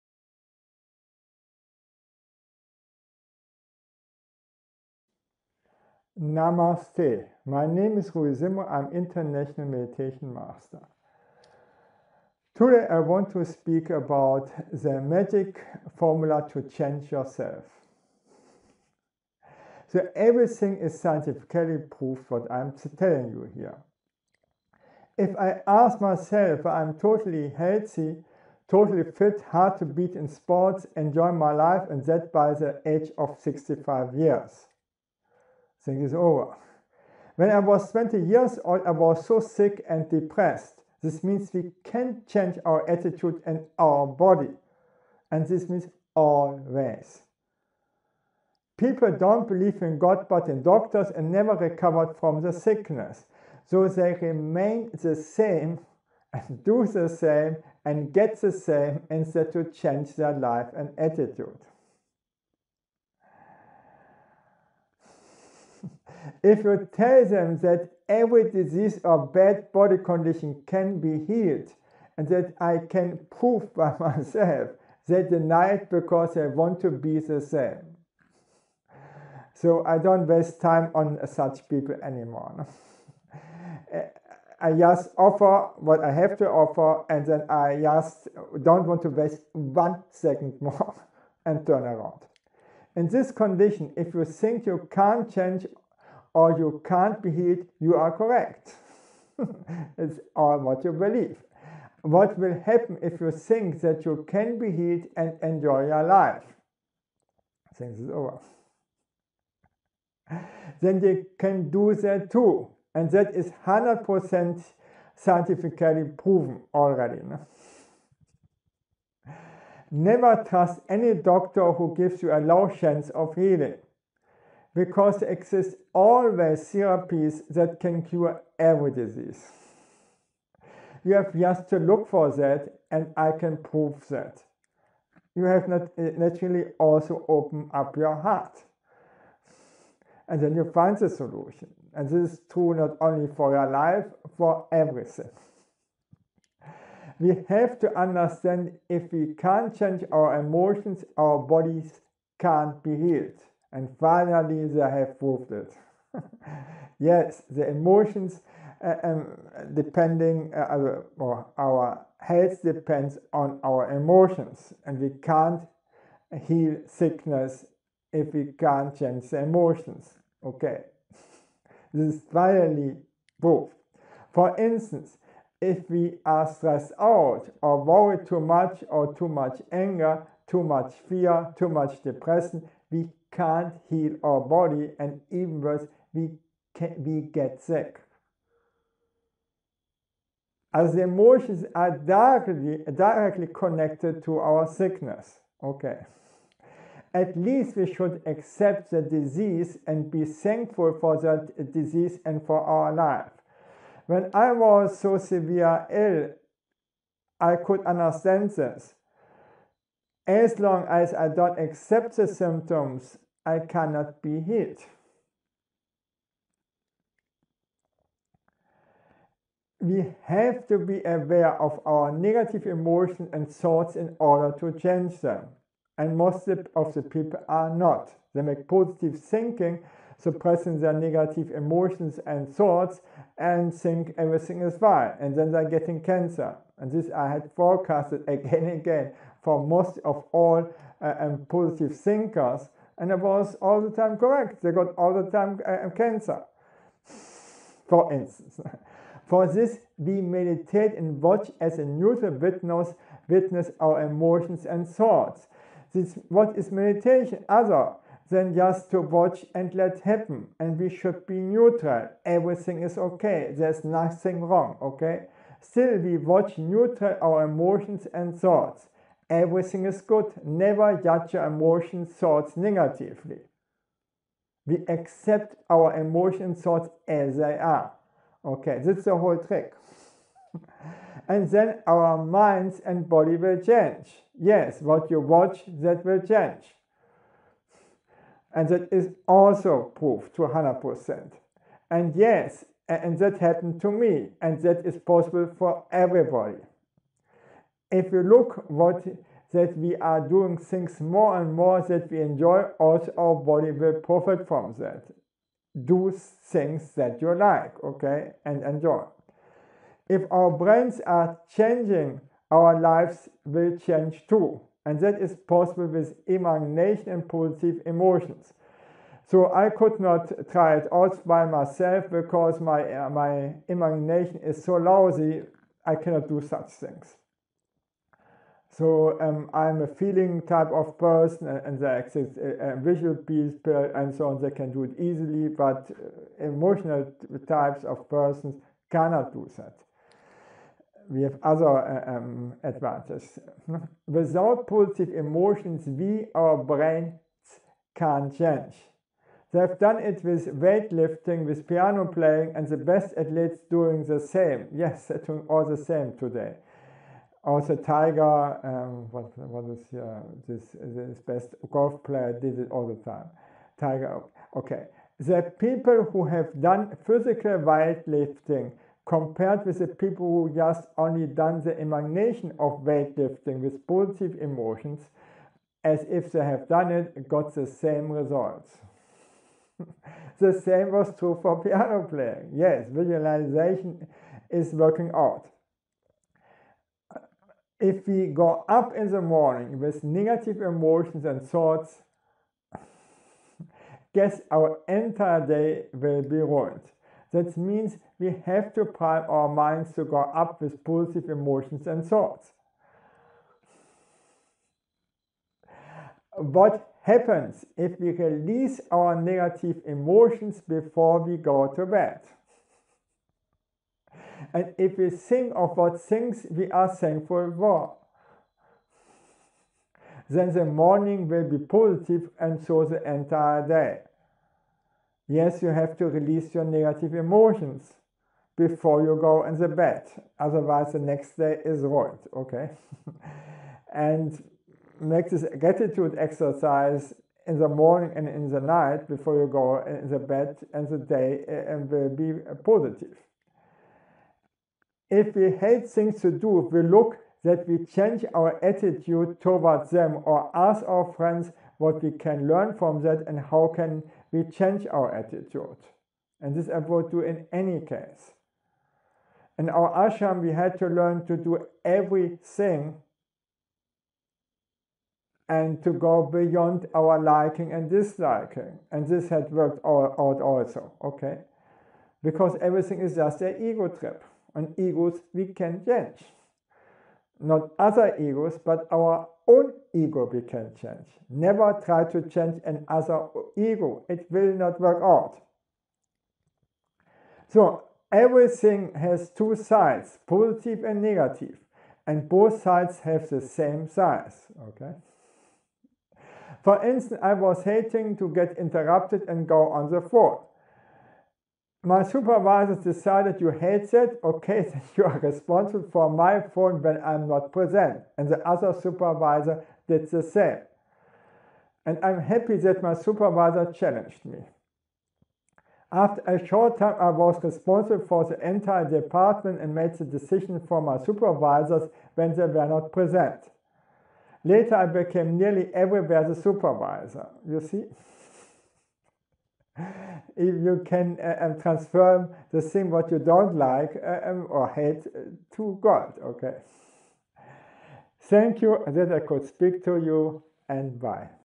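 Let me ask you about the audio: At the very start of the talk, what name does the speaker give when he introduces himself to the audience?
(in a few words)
Rudi Zimmerer.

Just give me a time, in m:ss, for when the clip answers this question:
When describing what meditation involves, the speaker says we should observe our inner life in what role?
4:11.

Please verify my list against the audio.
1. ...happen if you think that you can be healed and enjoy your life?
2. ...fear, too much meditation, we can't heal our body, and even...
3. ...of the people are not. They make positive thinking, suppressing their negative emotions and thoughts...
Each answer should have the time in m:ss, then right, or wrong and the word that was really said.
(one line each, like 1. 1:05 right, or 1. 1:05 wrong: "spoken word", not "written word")
1. 1:42 right
2. 3:01 wrong: "depression", not "meditation"
3. 3:46 right.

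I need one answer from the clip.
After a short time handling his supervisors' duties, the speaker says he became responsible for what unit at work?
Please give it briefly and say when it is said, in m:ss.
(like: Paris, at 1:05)
The entire department, at 8:38.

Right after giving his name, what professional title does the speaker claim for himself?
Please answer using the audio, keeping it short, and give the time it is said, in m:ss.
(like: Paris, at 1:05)
International Meditation Master, at 0:08.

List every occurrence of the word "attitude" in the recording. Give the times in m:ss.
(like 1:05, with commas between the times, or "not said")
0:42, 1:00, 7:28, 7:35.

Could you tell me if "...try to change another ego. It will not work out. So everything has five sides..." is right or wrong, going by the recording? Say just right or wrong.
wrong.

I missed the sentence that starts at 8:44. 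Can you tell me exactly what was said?
Later, I became nearly everywhere the supervisor.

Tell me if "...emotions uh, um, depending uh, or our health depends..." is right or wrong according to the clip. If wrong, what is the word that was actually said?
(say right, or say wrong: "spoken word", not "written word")
right.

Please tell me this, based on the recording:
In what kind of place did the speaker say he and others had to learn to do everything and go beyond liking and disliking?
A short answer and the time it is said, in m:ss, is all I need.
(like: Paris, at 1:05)
Ashram, at 7:40.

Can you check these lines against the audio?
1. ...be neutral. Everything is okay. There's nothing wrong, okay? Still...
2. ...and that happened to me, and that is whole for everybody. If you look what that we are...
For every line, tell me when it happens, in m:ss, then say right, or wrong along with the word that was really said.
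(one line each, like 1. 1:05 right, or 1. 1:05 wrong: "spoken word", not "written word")
1. 4:21 right
2. 4:52 wrong: "possible", not "whole".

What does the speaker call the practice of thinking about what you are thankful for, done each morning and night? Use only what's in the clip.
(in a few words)
Gratitude exercise.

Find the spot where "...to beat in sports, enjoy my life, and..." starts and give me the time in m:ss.
0:29.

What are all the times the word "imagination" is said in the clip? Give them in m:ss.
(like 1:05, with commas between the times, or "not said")
5:16, 5:23, 6:11.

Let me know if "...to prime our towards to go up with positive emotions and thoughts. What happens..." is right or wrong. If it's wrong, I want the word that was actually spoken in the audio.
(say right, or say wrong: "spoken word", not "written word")
wrong: "minds", not "towards".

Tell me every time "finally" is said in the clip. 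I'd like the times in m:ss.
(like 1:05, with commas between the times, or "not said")
2:33, 2:52.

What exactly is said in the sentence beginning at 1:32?
In this condition, if you think you can't change or you can't be healed, you are correct.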